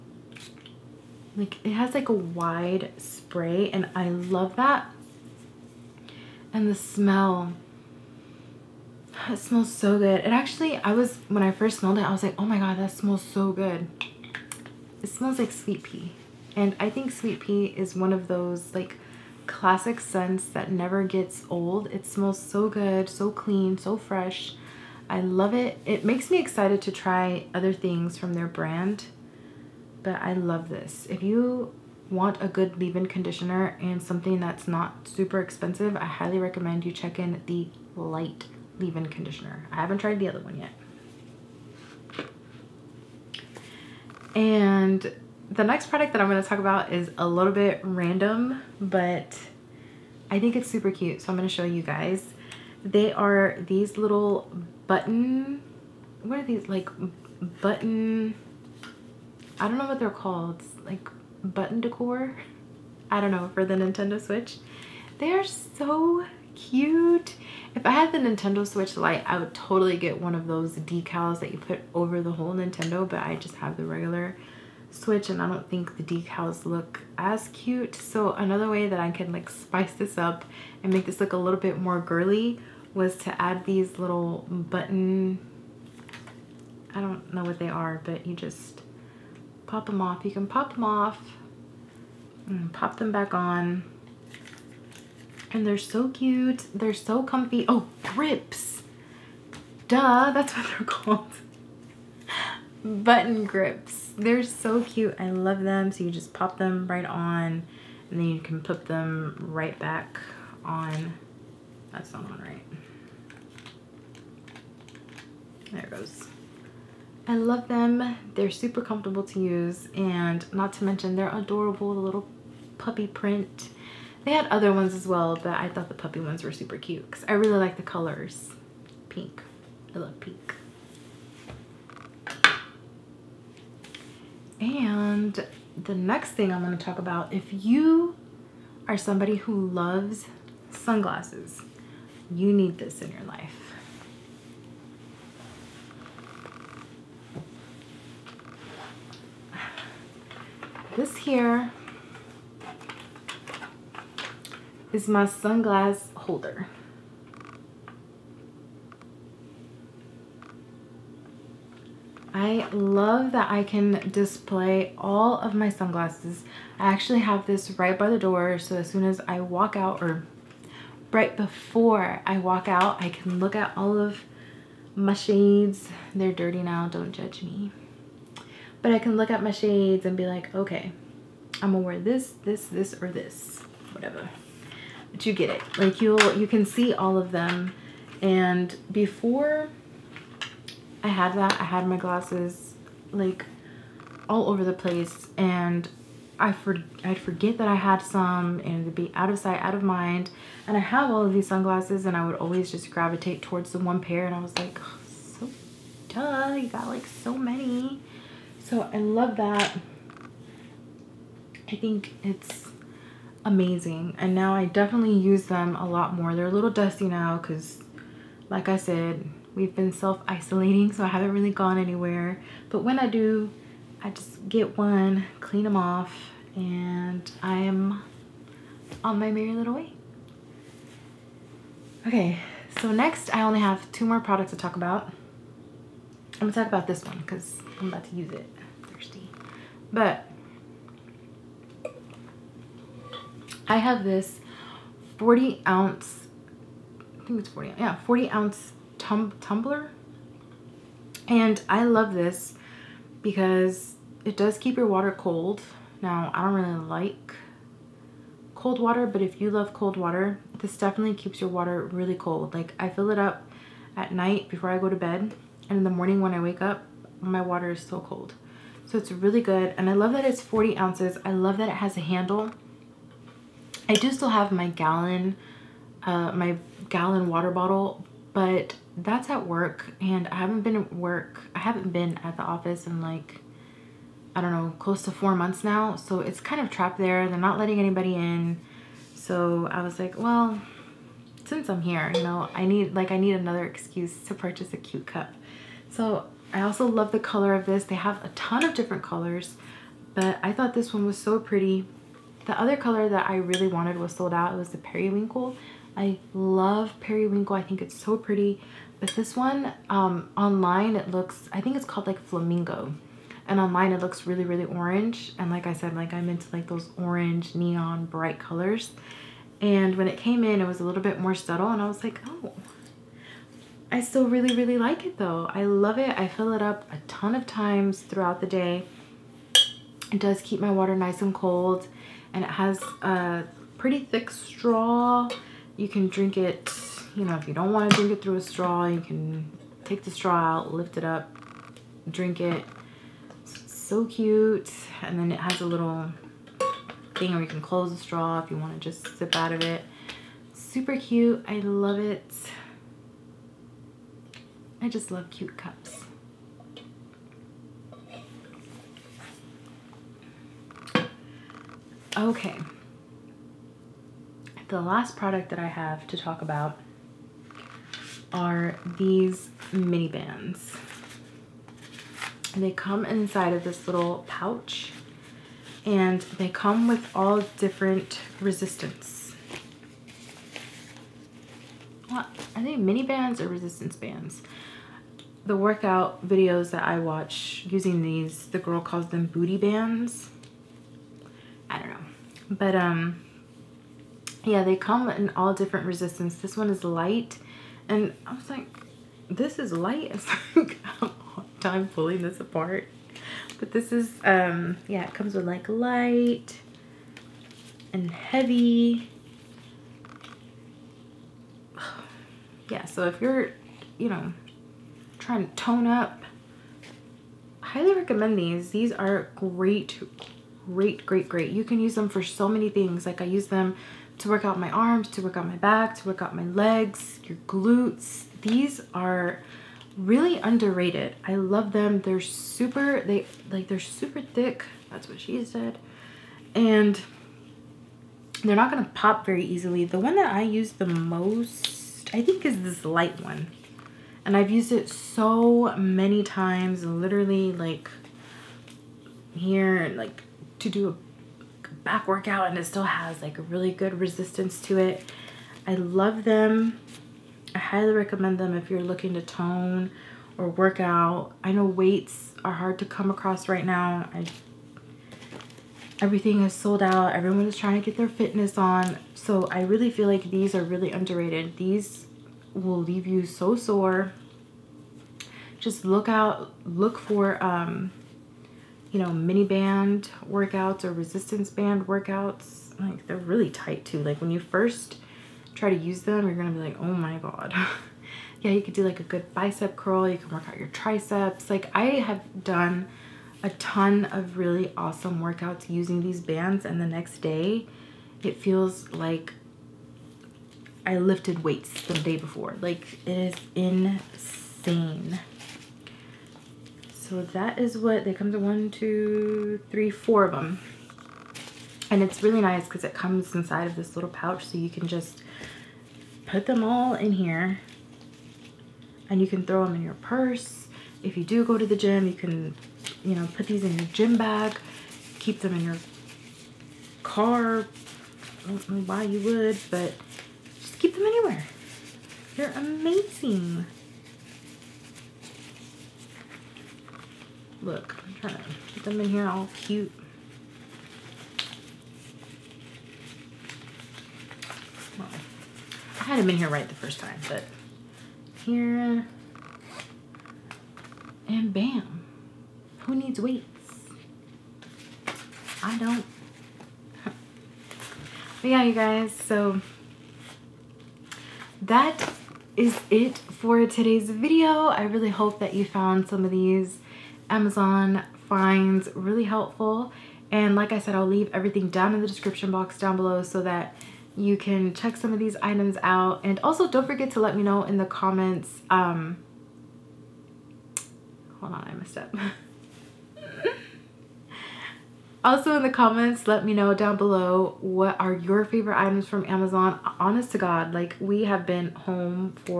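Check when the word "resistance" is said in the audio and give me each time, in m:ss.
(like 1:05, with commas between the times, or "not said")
6:18, 6:23, 6:35, 7:33, 8:00.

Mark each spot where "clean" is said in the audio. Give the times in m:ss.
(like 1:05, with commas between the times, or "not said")
0:23, 3:45.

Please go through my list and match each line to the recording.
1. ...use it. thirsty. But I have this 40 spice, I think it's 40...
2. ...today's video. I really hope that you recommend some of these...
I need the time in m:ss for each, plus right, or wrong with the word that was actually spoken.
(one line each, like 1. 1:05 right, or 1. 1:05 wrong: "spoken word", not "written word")
1. 3:58 wrong: "ounce", not "spice"
2. 9:23 wrong: "found", not "recommend".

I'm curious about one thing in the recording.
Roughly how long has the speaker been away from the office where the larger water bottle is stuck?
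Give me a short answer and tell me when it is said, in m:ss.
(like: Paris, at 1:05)
Close to 4 months, at 4:44.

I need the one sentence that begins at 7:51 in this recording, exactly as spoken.
These will leave you so sore.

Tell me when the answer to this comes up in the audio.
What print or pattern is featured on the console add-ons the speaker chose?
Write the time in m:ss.
2:02.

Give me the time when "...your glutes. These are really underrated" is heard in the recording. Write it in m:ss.
7:07.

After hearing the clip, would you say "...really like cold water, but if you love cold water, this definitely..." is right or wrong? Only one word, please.
right.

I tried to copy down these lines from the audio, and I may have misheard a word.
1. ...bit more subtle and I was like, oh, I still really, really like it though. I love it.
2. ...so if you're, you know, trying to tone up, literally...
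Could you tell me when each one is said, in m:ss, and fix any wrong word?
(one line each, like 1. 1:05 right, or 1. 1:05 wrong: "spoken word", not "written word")
1. 5:21 right
2. 6:52 wrong: "highly", not "literally".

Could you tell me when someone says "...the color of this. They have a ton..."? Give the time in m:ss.
4:57.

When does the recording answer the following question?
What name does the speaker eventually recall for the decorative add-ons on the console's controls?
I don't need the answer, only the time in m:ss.
1:42.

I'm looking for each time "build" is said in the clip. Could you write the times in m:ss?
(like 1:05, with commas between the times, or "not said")
not said.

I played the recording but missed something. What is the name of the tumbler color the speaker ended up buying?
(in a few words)
Flamingo.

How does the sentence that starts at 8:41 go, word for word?
If you do go to the gym, you can, you know, put these in your gym bag, keep them in your car.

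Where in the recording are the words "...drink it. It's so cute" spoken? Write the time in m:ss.
5:42.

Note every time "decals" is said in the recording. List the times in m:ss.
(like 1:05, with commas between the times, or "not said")
1:10, 1:16.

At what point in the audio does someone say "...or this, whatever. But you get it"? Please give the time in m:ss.
3:03.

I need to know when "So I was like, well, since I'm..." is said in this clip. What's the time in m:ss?
4:49.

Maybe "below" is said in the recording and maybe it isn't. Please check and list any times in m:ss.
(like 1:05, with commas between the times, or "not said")
9:32, 9:46.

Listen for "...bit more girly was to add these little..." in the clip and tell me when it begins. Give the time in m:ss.
1:21.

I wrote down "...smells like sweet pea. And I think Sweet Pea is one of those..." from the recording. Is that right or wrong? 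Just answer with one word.
right.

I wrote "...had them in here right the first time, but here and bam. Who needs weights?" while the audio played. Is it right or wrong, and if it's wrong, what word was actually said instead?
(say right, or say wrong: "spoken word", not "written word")
right.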